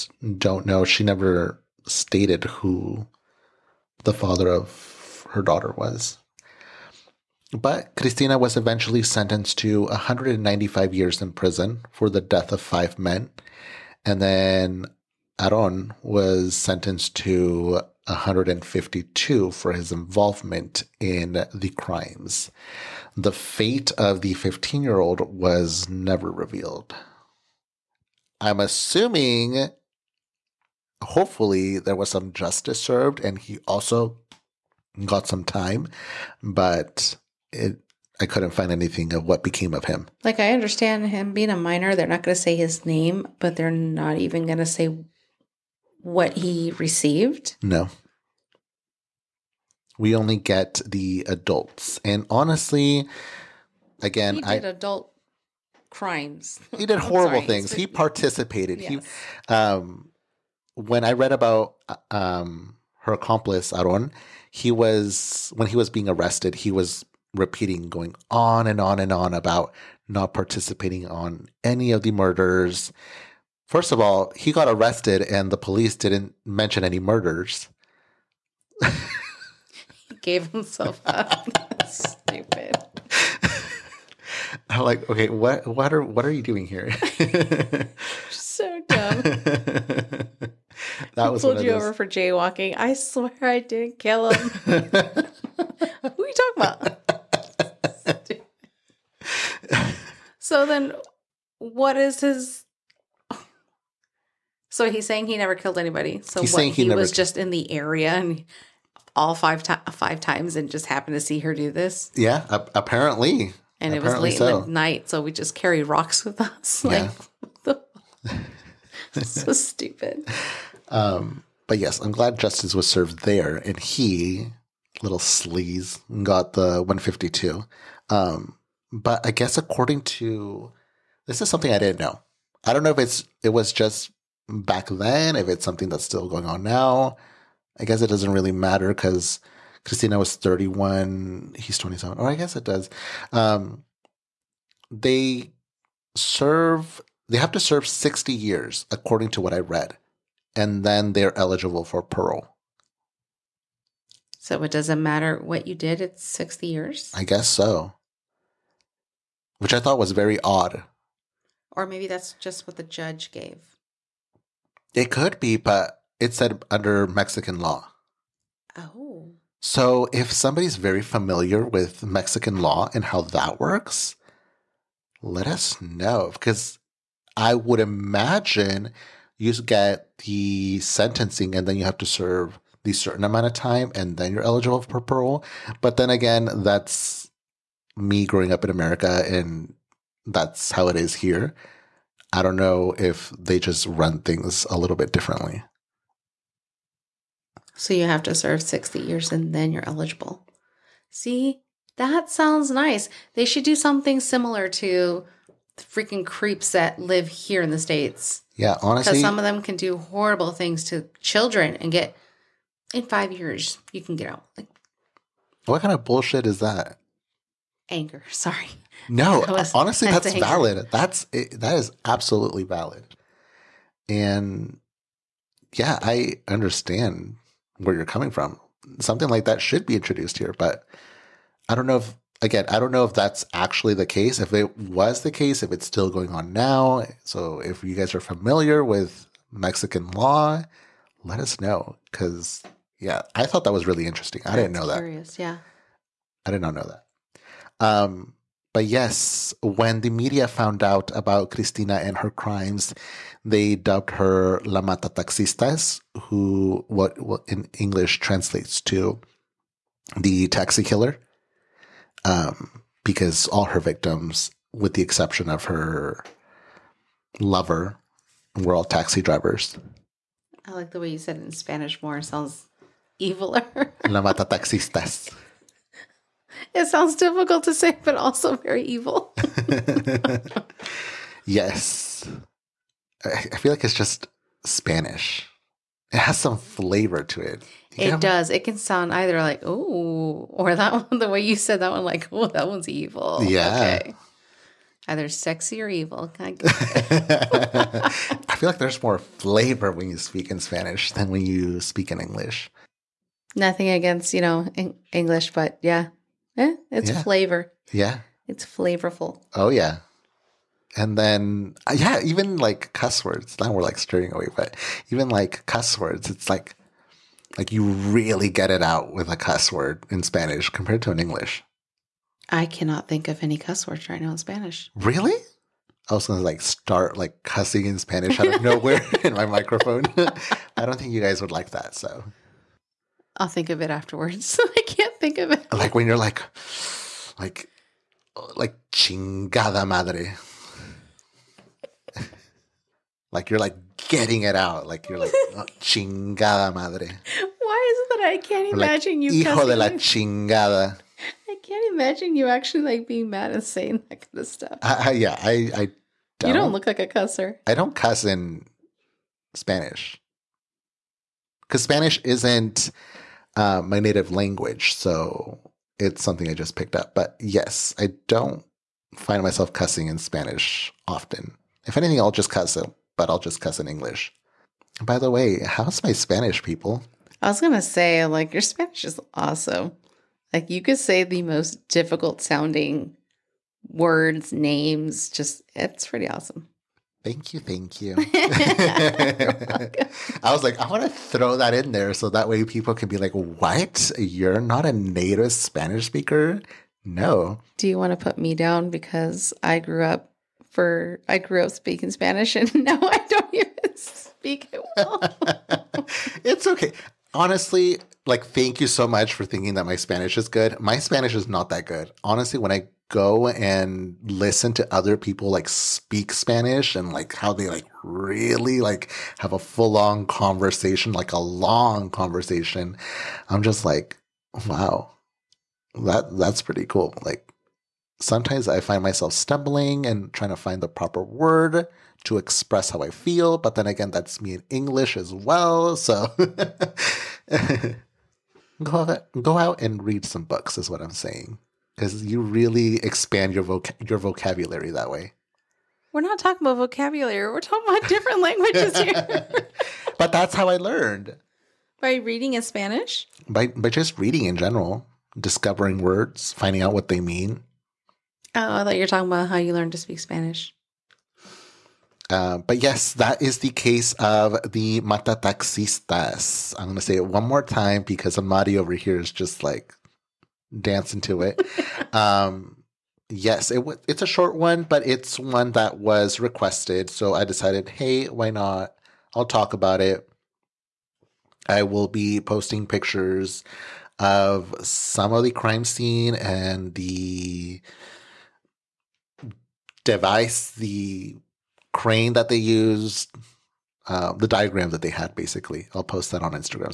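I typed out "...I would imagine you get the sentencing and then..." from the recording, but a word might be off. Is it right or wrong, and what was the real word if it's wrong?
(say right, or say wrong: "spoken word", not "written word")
right.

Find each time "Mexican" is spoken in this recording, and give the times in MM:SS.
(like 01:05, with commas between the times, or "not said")
02:47, 02:52, 03:59.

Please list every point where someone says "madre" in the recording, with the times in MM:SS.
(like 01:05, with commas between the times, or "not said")
05:39, 05:46.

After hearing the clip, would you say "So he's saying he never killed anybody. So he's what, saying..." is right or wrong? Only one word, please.
right.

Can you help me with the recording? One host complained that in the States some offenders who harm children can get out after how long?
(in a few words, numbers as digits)
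five years.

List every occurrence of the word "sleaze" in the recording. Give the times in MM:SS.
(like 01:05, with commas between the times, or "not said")
02:05.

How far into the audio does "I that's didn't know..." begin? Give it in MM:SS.
04:04.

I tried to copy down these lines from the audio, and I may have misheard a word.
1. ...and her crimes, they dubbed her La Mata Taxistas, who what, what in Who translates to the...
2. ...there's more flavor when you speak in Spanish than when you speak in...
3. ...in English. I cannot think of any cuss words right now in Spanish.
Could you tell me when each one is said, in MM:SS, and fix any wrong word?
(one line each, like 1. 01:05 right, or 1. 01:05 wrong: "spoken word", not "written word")
1. 04:11 wrong: "English", not "Who"
2. 04:58 right
3. 05:21 right.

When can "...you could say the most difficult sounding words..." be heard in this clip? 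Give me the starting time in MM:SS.
06:20.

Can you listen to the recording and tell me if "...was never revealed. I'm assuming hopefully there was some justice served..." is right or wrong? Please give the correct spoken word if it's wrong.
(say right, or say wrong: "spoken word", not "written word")
right.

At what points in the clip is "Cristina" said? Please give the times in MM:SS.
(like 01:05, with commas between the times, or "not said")
00:07, 02:19, 04:11.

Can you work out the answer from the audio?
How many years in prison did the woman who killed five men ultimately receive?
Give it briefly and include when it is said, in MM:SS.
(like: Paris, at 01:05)
195 years, at 00:09.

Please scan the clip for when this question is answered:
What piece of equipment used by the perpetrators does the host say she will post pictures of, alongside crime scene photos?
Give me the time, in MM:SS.
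08:10.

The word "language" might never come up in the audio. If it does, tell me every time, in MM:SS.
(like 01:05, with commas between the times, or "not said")
06:04, 07:28.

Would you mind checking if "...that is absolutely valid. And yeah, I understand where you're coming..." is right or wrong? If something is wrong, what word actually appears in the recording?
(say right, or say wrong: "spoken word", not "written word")
right.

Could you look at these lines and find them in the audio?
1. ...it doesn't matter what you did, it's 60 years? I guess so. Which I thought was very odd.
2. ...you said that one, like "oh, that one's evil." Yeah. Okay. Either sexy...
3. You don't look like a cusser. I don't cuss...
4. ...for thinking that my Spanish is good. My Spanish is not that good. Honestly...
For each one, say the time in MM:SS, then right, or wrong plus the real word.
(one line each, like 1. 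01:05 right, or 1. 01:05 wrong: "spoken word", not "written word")
1. 02:34 right
2. 04:51 right
3. 05:56 right
4. 06:49 right.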